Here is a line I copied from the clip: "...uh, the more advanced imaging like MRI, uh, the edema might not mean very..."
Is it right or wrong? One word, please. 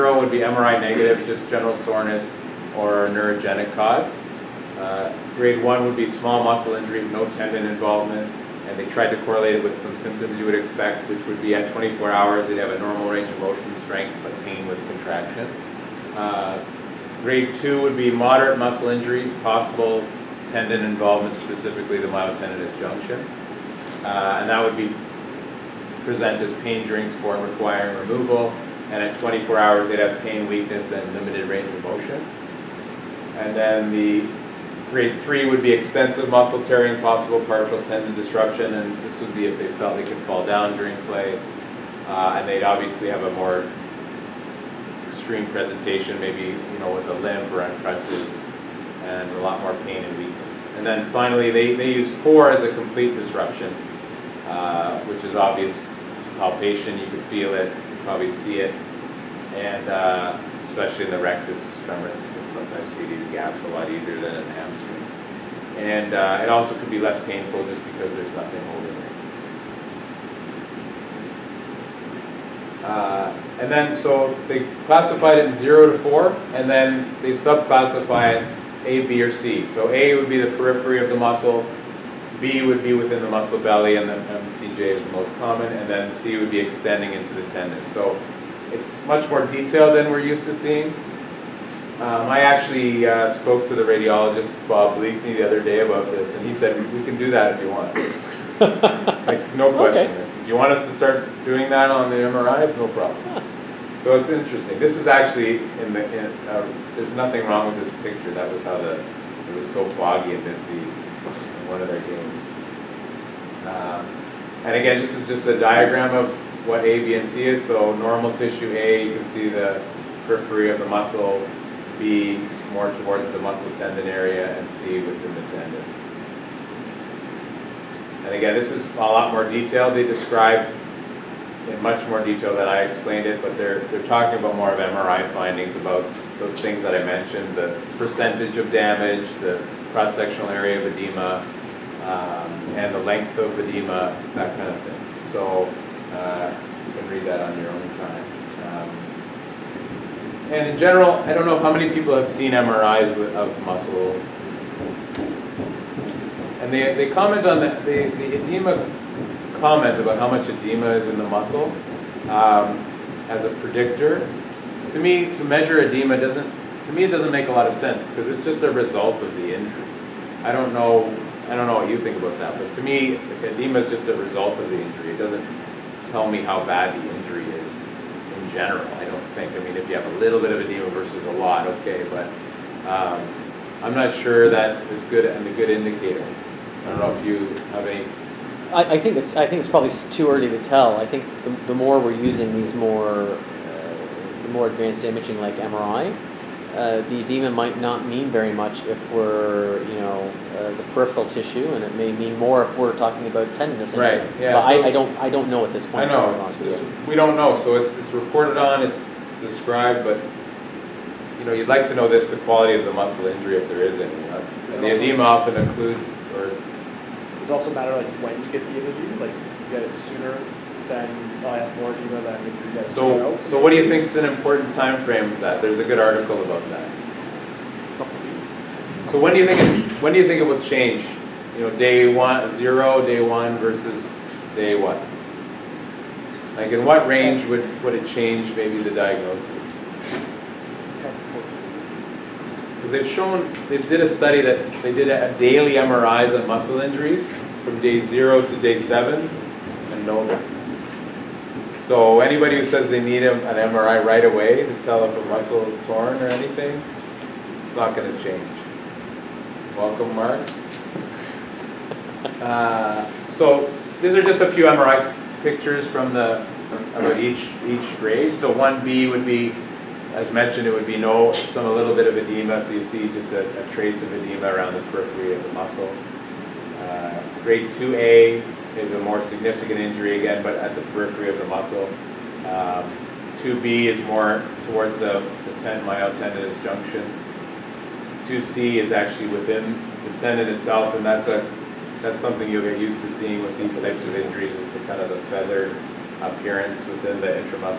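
right.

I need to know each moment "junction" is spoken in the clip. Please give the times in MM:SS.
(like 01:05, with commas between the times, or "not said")
00:22, 04:46.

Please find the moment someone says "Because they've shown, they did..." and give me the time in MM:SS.
04:02.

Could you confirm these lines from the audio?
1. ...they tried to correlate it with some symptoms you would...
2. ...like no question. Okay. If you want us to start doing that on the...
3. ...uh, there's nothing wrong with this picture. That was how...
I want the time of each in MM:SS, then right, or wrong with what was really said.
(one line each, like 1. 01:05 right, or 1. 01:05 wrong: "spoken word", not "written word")
1. 00:08 right
2. 01:39 right
3. 01:46 right.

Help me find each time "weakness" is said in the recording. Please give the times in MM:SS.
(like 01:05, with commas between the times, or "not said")
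00:30, 00:50.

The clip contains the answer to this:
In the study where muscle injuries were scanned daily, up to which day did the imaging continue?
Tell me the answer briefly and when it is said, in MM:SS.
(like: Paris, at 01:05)
Day 7, at 04:08.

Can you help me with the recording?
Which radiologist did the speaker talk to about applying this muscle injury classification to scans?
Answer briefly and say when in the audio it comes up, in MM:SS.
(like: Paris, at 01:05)
Bob Bleakney, at 01:34.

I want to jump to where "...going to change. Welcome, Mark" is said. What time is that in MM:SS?
04:17.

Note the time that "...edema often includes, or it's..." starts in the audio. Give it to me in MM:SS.
03:34.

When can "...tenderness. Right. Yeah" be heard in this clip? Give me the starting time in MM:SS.
03:23.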